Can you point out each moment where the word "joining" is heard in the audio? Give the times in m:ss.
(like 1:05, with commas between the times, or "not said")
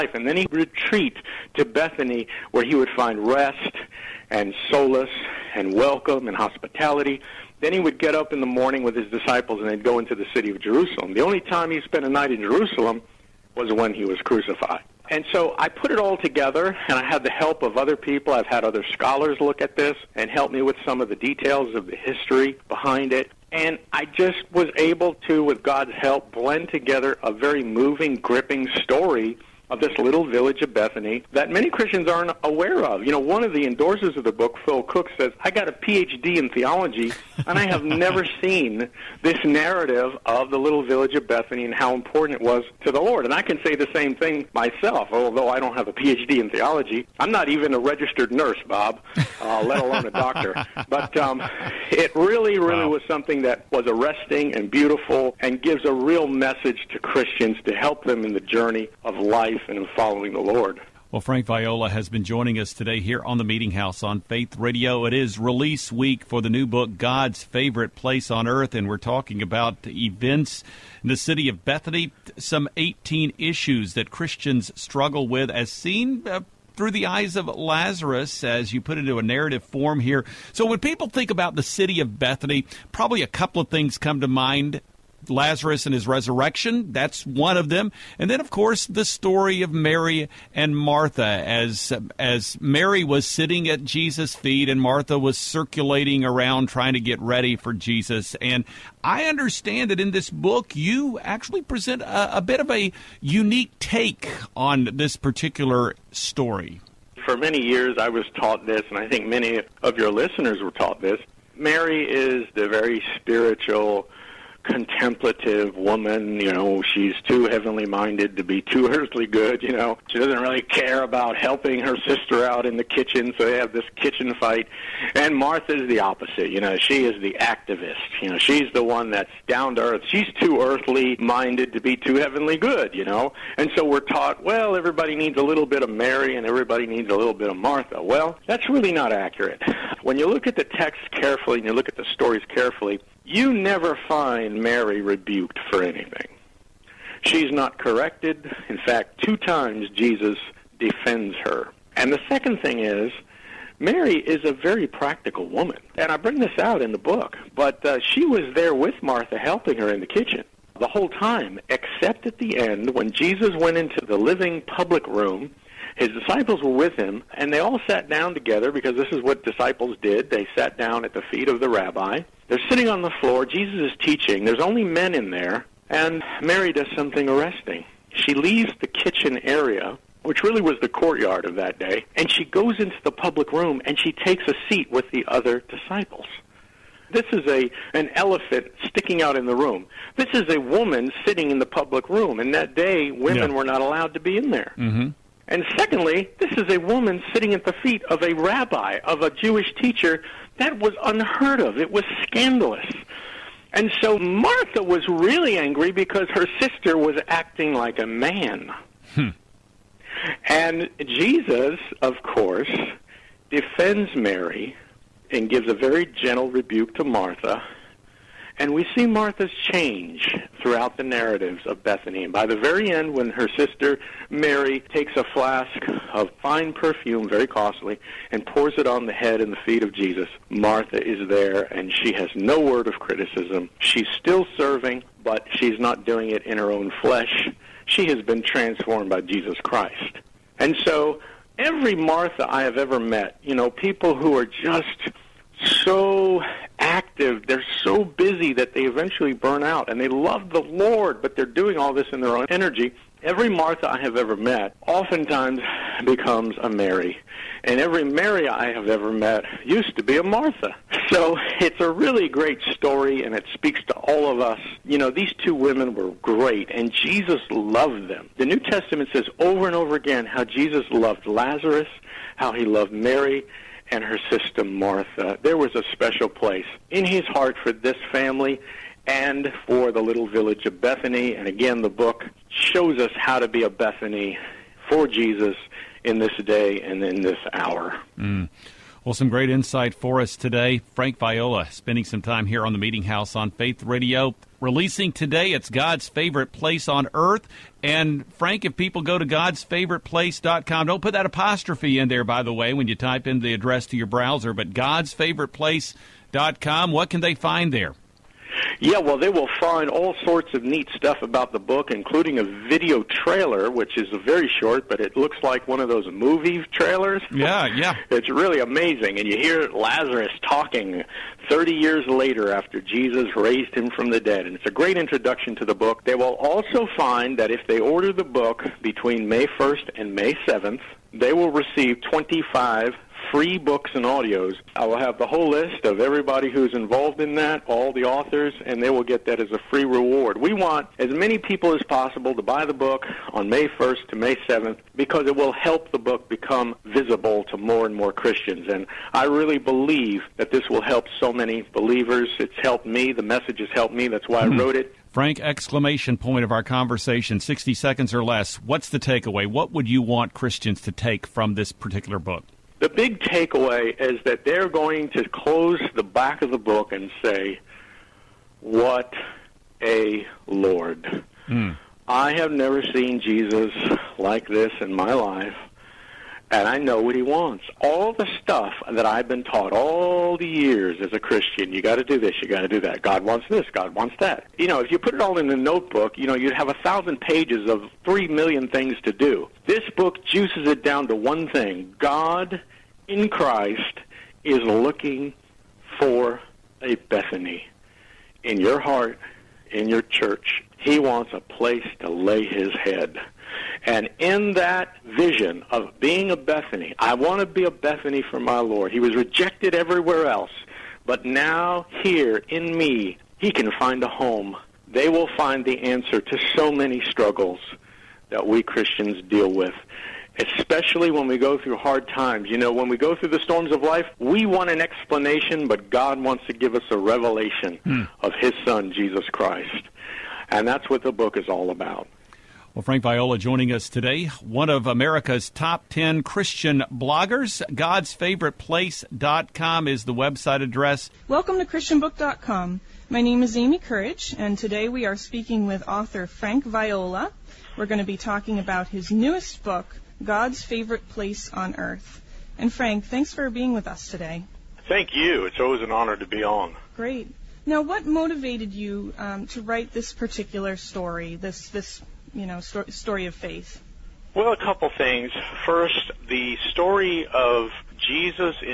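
1:02, 7:13.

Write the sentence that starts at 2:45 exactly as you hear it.
His disciples were with him, and they all sat down together because this is what disciples did.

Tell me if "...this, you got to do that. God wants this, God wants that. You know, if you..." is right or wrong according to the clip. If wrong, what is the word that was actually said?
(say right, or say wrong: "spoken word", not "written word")
right.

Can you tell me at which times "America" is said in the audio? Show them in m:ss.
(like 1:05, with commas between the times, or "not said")
7:14.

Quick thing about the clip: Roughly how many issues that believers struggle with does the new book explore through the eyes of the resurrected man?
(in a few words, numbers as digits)
18.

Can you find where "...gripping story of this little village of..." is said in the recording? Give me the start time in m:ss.
0:28.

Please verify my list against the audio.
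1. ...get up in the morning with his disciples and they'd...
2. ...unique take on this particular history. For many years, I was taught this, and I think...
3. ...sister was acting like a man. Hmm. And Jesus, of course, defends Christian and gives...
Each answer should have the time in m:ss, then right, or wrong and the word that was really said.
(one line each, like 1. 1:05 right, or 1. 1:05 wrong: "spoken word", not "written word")
1. 0:07 right
2. 1:43 wrong: "story", not "history"
3. 3:26 wrong: "Mary", not "Christian".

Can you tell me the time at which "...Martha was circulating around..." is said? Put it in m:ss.
1:34.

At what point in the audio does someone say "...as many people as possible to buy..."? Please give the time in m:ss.
5:40.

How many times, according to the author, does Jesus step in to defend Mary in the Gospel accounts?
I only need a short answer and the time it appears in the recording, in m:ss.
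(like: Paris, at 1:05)
2, at 2:29.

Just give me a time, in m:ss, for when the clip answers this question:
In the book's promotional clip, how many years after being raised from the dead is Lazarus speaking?
5:21.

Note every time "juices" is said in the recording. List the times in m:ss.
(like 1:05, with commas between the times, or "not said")
6:30.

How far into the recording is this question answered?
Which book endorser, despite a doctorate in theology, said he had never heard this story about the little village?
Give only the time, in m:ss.
0:34.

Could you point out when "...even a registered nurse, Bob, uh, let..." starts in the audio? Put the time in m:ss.
0:47.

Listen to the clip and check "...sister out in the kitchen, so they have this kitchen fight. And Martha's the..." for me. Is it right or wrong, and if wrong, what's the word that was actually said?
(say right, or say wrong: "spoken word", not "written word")
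right.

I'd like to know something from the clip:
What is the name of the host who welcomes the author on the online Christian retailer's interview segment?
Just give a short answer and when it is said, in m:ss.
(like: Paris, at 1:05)
Amy Courage, at 7:23.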